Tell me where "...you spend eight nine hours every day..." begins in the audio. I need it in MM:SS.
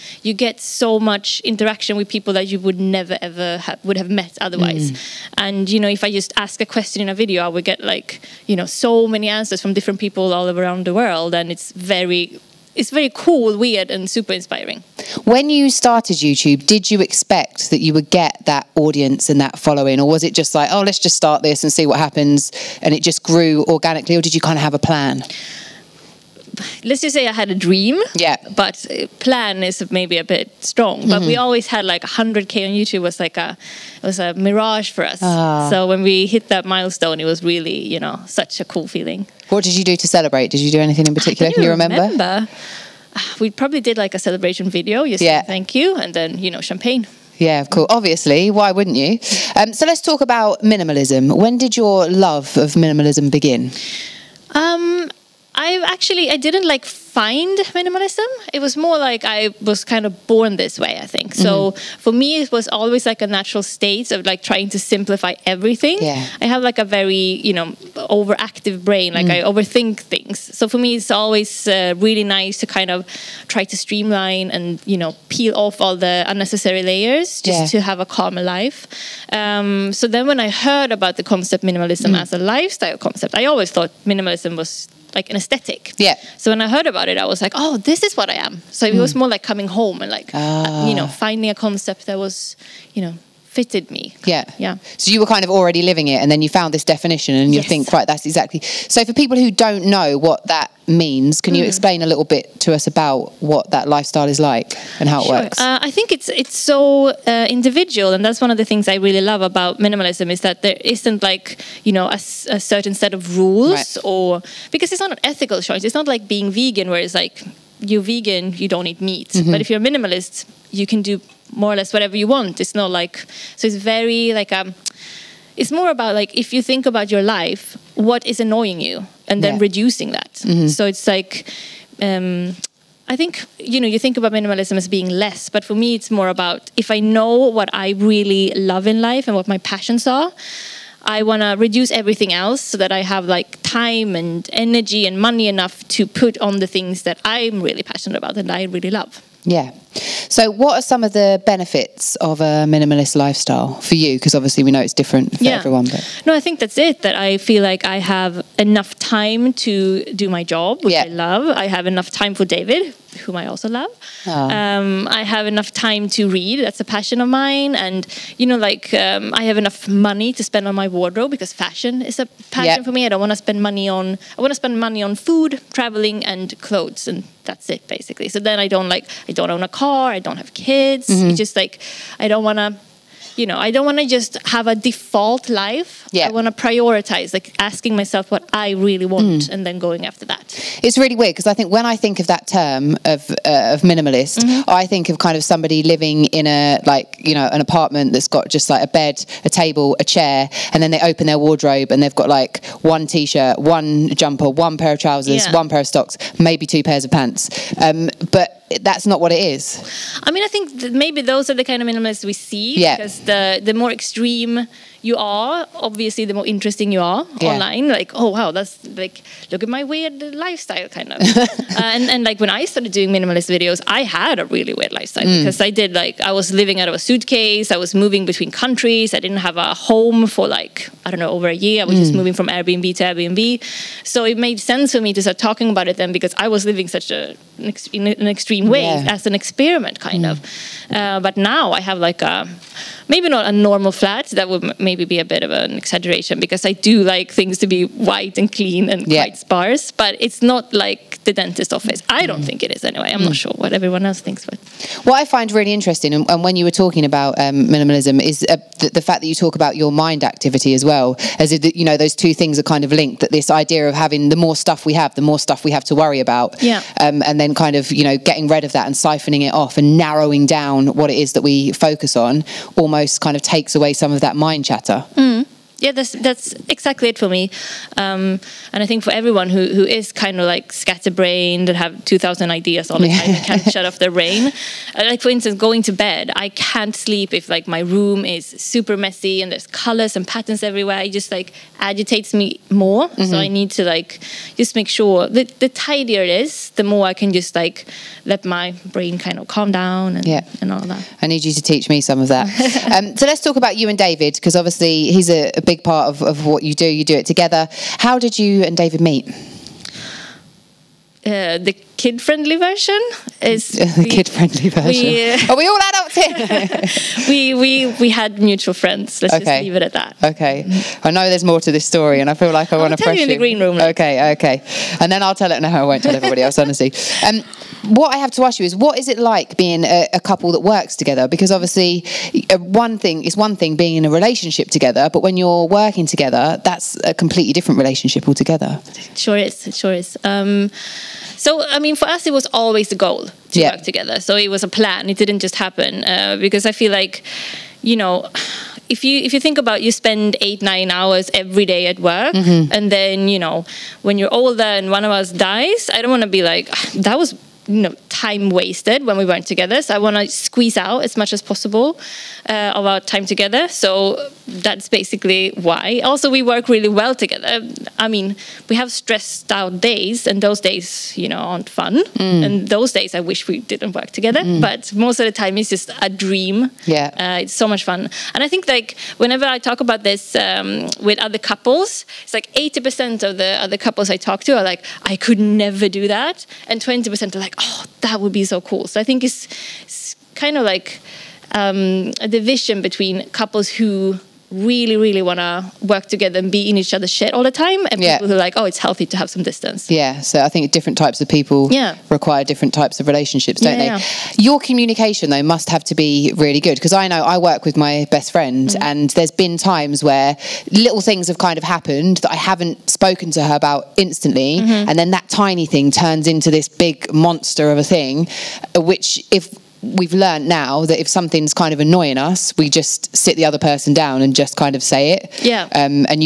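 05:49.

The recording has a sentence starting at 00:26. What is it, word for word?
let's just say I had a dream.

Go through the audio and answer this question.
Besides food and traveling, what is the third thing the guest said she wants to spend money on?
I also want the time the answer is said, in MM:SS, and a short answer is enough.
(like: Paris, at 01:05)
clothes, at 02:56.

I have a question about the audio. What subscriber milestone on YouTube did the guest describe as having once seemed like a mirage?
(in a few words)
100k.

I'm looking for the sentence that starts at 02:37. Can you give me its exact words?
That I feel like I have enough time to do my job, which yeah.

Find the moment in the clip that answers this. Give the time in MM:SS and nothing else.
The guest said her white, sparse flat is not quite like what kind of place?
04:11.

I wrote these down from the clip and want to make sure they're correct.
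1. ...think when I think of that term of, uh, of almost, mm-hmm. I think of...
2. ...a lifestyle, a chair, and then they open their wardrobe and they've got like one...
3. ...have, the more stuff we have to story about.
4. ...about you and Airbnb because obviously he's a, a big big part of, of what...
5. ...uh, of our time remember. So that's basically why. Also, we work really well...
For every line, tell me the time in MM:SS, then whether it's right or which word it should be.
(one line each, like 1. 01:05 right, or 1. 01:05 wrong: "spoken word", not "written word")
1. 03:11 wrong: "minimalist", not "almost"
2. 03:19 wrong: "table", not "lifestyle"
3. 04:24 wrong: "worry", not "story"
4. 05:03 wrong: "David", not "Airbnb"
5. 06:02 wrong: "together", not "remember".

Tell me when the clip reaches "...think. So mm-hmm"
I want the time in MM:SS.
01:01.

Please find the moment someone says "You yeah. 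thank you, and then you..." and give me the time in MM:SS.
00:45.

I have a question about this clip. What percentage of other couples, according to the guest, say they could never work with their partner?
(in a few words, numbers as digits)
80%.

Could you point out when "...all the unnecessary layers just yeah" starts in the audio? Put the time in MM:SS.
01:15.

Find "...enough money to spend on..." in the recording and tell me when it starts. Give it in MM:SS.
02:49.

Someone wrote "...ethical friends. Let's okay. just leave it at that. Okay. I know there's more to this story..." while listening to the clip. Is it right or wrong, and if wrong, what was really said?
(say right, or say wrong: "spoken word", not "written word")
wrong: "mutual", not "ethical".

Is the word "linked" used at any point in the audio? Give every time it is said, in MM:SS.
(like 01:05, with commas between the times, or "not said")
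04:22.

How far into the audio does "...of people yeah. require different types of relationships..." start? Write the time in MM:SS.
06:41.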